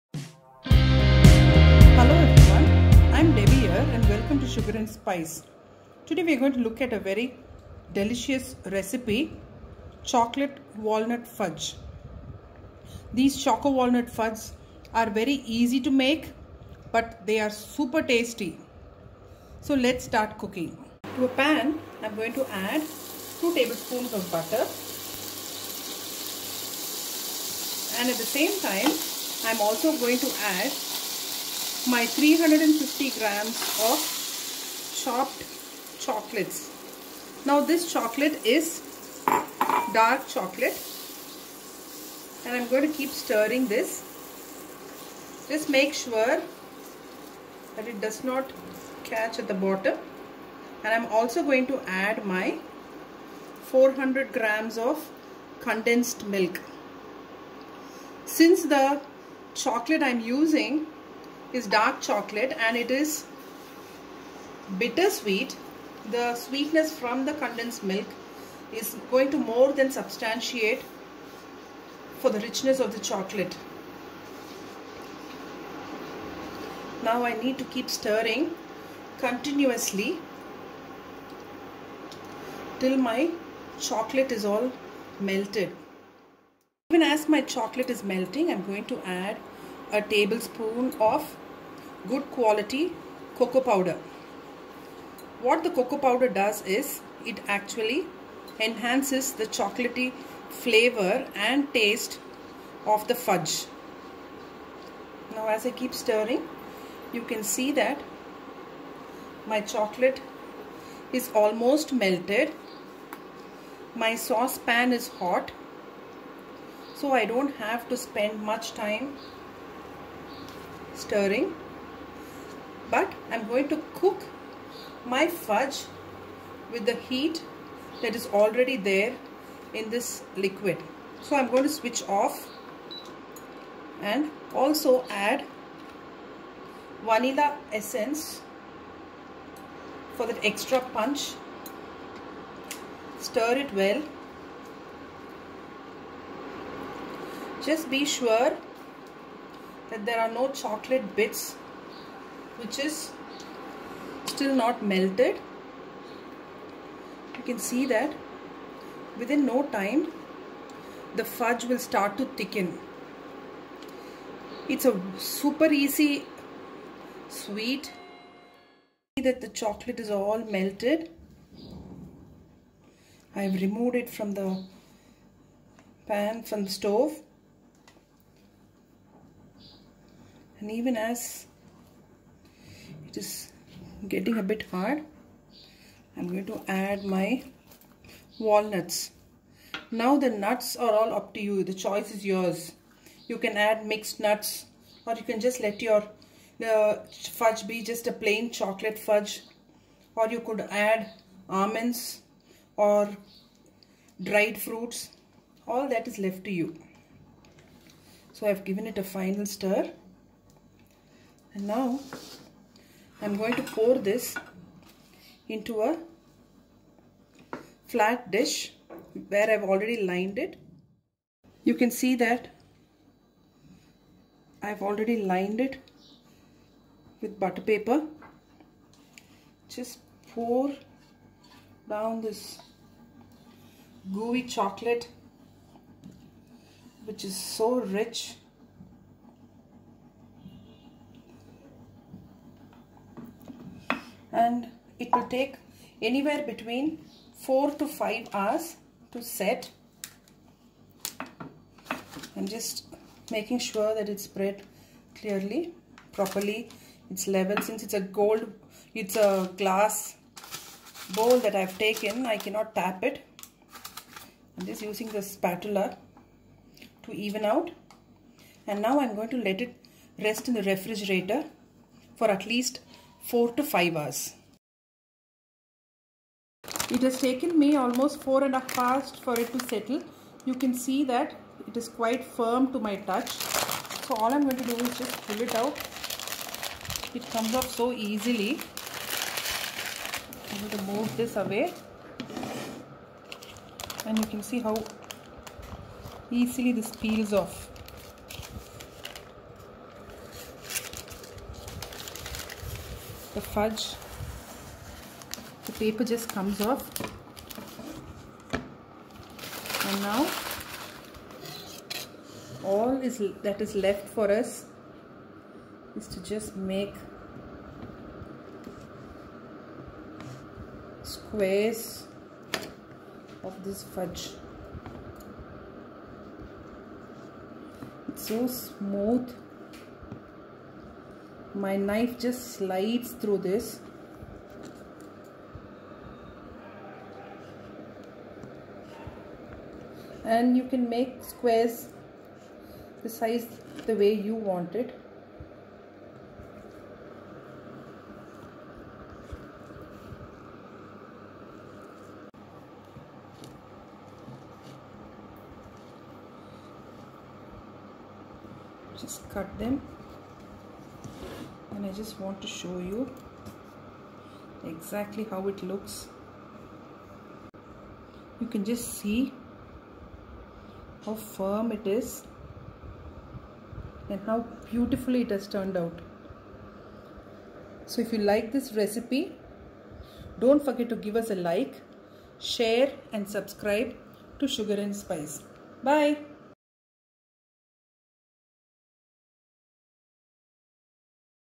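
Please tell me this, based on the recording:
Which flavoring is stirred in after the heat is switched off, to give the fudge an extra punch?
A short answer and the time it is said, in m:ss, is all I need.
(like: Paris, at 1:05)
vanilla essence, at 2:17.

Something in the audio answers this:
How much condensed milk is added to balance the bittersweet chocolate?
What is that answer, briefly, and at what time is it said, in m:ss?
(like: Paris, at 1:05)
400 grams, at 0:53.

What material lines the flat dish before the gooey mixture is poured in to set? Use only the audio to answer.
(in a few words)
butter paper.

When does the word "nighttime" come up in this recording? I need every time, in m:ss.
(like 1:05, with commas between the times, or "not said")
not said.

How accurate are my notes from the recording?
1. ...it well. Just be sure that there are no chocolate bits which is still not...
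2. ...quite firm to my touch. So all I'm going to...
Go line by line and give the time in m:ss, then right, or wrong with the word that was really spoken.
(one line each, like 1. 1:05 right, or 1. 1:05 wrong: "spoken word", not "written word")
1. 2:23 right
2. 4:41 right.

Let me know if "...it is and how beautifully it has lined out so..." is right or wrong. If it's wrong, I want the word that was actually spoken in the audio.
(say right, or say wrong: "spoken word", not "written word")
wrong: "turned", not "lined".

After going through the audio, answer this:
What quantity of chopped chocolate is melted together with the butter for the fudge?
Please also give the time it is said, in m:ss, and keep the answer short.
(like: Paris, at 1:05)
350 grams, at 0:32.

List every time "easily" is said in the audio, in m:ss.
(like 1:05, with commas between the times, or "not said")
4:47, 4:56.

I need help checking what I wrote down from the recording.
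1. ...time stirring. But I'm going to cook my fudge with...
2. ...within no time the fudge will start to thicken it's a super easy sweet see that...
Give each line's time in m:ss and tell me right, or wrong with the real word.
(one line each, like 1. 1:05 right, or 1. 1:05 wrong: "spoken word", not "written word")
1. 1:58 right
2. 2:39 right.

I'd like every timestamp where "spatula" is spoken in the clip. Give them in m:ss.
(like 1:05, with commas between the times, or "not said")
4:25.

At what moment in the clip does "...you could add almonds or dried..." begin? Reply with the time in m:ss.
3:20.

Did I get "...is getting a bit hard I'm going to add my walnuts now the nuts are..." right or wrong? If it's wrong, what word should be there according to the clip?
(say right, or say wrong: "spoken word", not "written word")
right.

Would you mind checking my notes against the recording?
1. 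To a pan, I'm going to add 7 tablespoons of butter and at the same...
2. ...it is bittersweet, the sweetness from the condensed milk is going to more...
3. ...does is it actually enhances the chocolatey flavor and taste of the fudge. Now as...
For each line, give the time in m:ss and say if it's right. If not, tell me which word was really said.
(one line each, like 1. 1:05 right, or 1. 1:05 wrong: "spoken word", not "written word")
1. 0:21 wrong: "2", not "7"
2. 1:02 right
3. 1:36 right.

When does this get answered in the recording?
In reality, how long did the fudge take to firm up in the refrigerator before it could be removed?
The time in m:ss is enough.
4:38.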